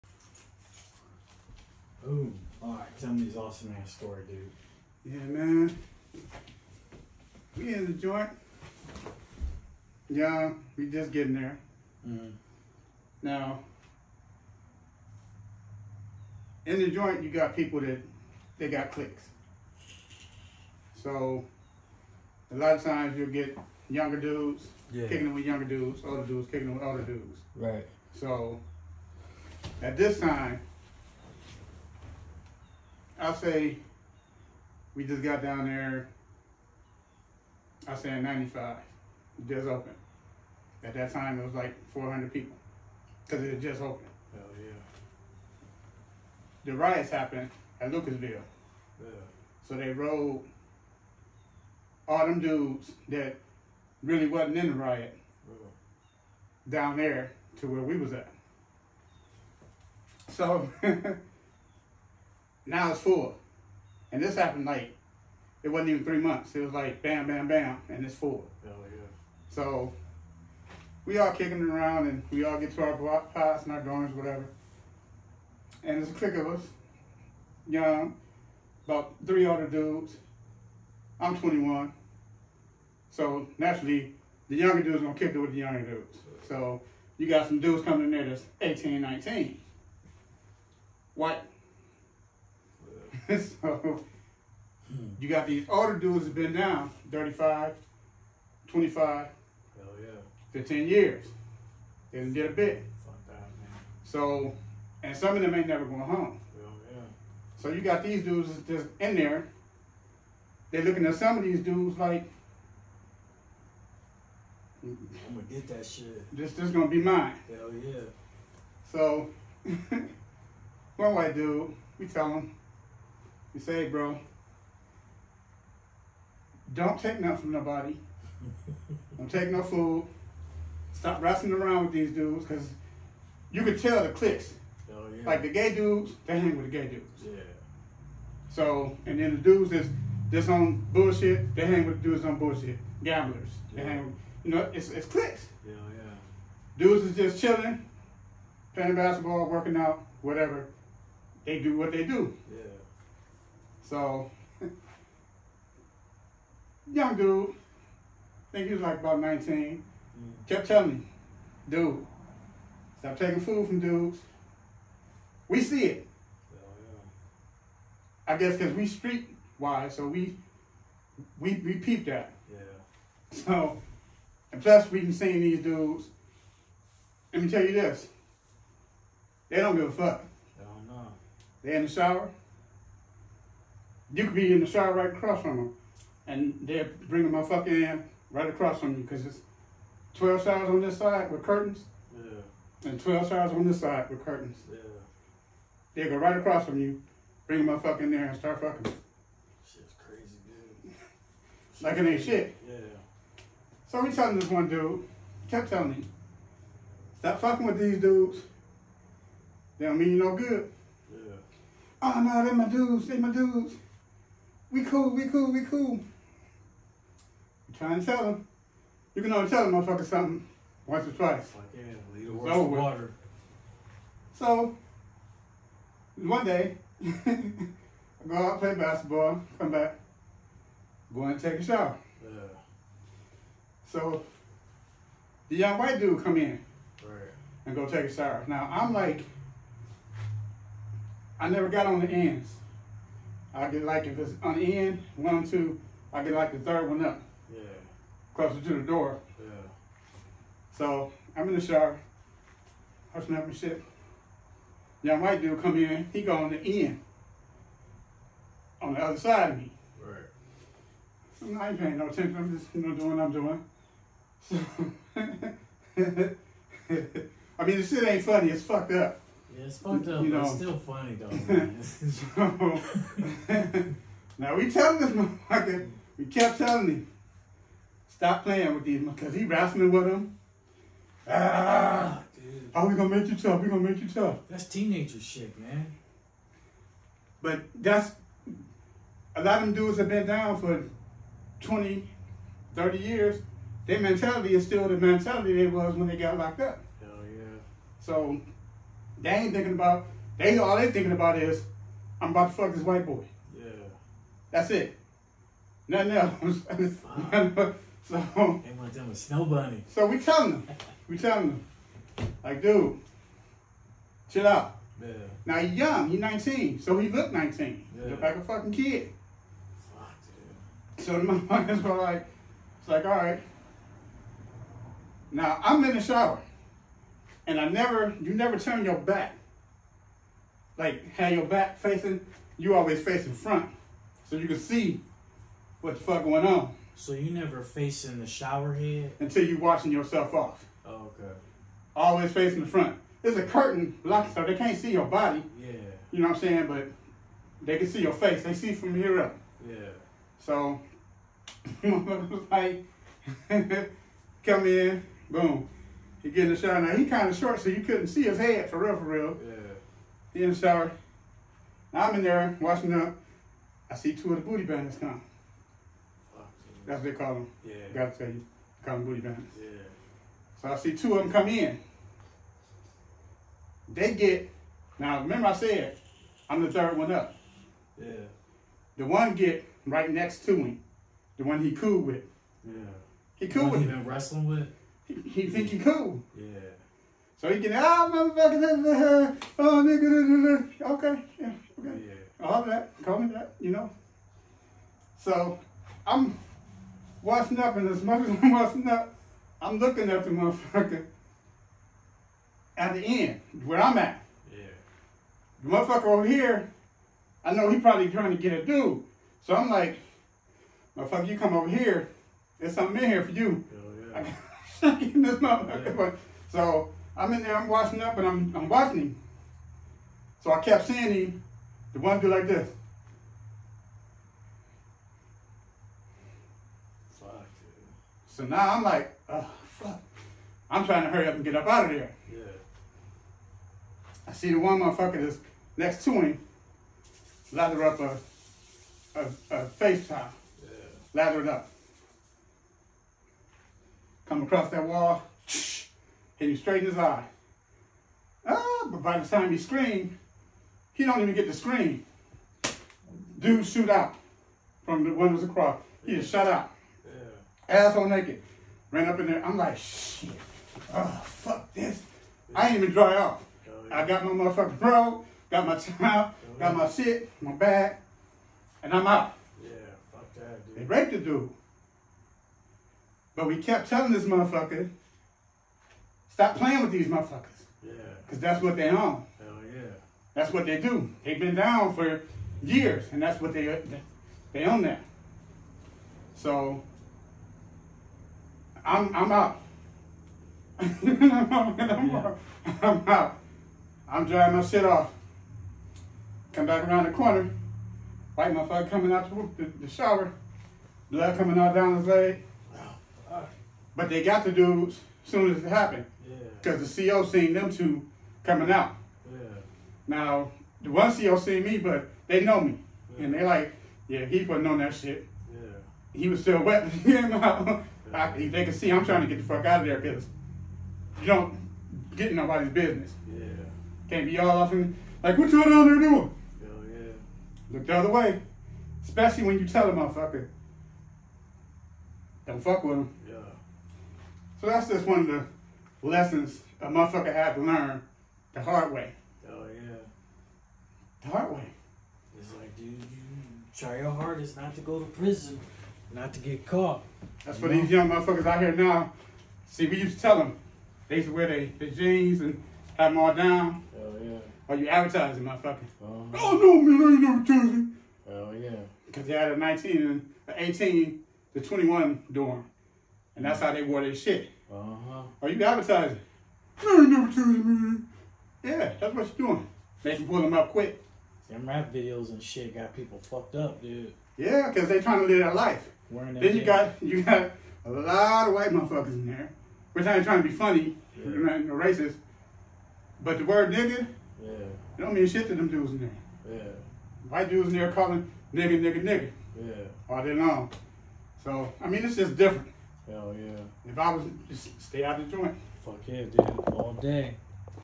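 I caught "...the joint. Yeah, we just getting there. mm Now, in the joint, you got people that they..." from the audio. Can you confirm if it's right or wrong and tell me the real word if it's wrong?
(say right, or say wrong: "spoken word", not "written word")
right.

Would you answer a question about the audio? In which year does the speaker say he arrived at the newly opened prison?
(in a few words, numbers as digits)
1995.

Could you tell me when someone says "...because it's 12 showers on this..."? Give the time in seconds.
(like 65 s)
189 s.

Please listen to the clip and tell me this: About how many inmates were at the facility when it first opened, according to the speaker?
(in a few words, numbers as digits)
400.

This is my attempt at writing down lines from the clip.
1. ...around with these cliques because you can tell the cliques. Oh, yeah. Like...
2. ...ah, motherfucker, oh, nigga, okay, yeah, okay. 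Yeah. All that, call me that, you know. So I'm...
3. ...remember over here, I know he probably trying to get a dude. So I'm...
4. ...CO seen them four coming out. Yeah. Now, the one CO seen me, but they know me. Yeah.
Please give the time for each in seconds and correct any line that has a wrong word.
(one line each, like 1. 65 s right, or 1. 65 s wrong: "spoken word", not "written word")
1. 131 s wrong: "dudes", not "cliques"
2. 387 s right
3. 405 s wrong: "motherfucker", not "remember"
4. 507 s wrong: "two", not "four".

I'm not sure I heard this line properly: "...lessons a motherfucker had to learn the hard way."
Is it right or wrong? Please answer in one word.
right.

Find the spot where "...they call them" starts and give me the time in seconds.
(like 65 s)
367 s.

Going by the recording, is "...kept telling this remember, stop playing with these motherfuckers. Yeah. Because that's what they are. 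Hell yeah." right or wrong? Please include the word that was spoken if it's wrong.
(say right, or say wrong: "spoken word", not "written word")
wrong: "motherfucker", not "remember".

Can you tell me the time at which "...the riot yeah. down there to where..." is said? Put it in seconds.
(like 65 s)
54 s.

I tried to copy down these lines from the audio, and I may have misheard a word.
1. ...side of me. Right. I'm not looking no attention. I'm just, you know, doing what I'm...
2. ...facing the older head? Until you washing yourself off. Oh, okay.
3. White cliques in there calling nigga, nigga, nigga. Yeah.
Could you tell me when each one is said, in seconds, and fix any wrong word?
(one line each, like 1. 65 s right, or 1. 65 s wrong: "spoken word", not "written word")
1. 259 s wrong: "paying", not "looking"
2. 337 s wrong: "shower", not "older"
3. 587 s wrong: "dudes", not "cliques".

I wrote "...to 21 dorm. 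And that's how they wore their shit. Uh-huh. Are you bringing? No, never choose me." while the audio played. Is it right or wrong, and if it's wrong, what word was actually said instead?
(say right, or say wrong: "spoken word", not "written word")
wrong: "advertising", not "bringing".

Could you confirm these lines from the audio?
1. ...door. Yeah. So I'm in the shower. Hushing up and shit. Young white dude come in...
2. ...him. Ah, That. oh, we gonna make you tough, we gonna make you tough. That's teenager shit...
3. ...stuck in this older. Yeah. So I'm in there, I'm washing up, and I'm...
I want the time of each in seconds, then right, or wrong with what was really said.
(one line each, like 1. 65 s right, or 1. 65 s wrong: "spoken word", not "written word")
1. 248 s right
2. 280 s wrong: "Dude", not "That"
3. 414 s wrong: "motherfucker", not "older".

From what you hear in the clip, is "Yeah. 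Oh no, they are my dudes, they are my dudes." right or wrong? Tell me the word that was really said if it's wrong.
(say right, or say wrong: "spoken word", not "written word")
right.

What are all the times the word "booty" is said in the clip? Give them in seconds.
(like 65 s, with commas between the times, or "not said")
364 s, 369 s.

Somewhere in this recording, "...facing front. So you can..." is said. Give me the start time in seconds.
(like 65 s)
333 s.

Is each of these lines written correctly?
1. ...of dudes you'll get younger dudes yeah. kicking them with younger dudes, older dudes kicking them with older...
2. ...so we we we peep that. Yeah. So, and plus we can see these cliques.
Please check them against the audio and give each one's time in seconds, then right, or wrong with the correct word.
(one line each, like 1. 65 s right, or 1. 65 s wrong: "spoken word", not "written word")
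1. 22 s wrong: "times", not "dudes"
2. 169 s wrong: "dudes", not "cliques".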